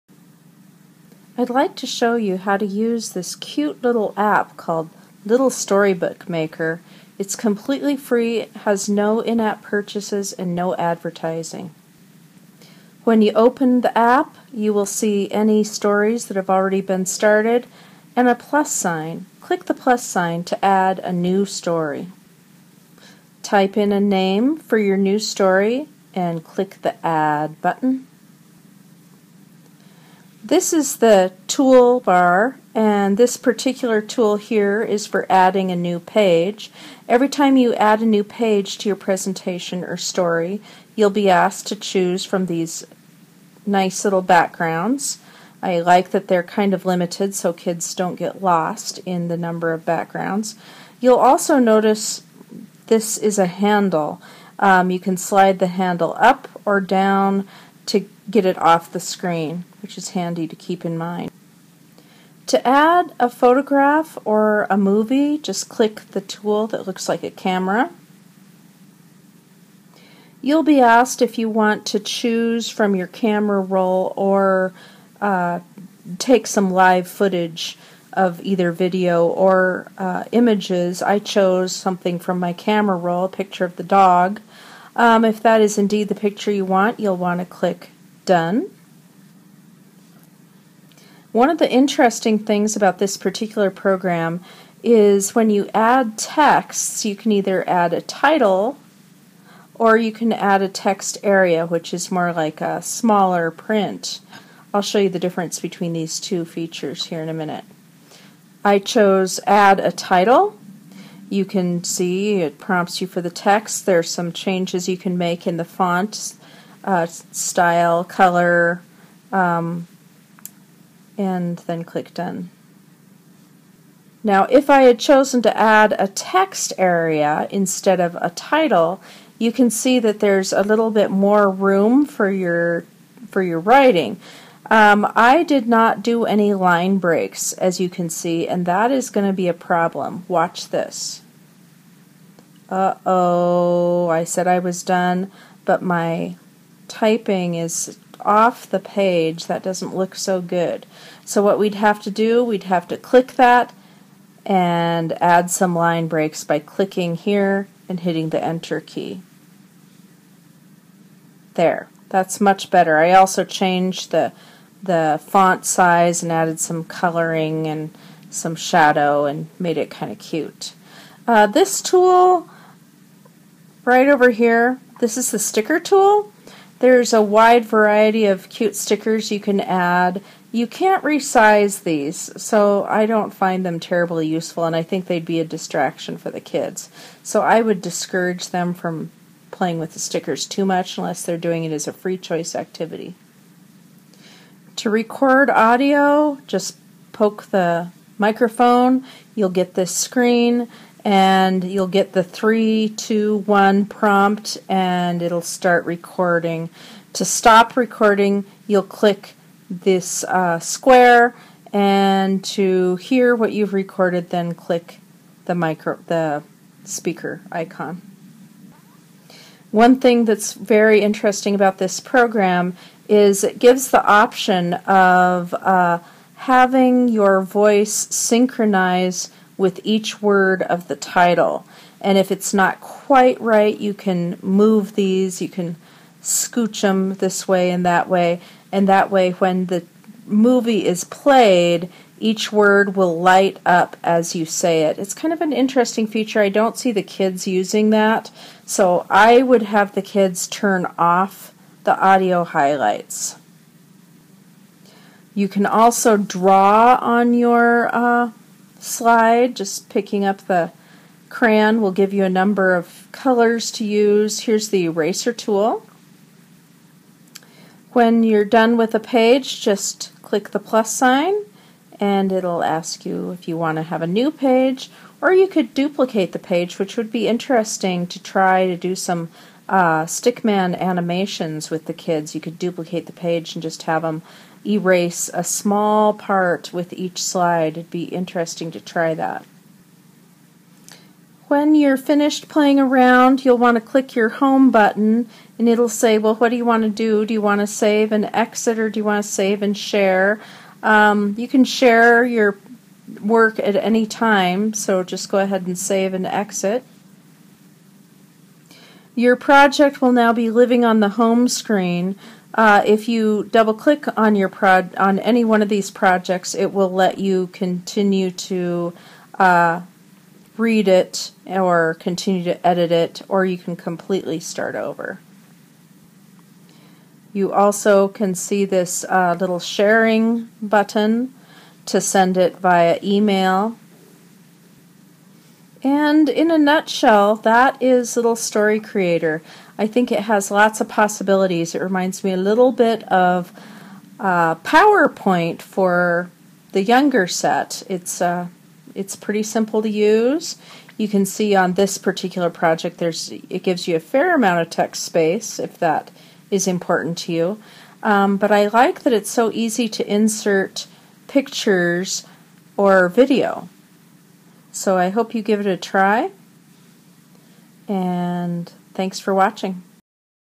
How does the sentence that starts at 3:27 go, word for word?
To stop recording, you'll click this uh, square, and to hear what you've recorded, then click the micro the speaker icon.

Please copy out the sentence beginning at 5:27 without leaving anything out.
You also can see this uh, little sharing button to send it via email.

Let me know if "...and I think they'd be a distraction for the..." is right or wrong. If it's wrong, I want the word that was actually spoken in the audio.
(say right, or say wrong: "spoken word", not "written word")
right.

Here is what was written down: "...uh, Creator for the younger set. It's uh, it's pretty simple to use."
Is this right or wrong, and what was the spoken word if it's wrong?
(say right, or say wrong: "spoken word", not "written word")
wrong: "PowerPoint", not "Creator".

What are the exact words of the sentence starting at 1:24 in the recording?
Um, if that is indeed the picture you want, you'll want to click Done.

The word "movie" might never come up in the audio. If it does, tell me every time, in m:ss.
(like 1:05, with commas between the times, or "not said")
1:04, 4:00.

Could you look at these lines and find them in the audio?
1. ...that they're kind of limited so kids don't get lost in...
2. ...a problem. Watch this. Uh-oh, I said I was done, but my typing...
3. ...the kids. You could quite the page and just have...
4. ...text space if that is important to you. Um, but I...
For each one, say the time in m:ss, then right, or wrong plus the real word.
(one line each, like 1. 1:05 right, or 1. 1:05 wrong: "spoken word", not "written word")
1. 0:46 right
2. 2:19 right
3. 4:41 wrong: "duplicate", not "quite"
4. 5:54 right.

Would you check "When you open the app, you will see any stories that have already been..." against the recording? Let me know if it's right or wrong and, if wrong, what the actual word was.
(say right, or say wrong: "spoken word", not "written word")
right.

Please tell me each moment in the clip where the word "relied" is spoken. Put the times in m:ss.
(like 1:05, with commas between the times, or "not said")
not said.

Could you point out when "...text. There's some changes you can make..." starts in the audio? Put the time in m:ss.
1:53.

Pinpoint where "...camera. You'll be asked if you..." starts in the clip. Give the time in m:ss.
1:07.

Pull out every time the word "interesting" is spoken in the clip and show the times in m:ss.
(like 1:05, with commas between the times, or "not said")
1:31, 3:40, 4:05, 4:37, 4:48.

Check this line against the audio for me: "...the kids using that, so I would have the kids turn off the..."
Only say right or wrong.
right.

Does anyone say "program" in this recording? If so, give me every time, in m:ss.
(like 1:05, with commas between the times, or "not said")
1:33, 3:42.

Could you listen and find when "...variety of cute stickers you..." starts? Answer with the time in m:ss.
2:57.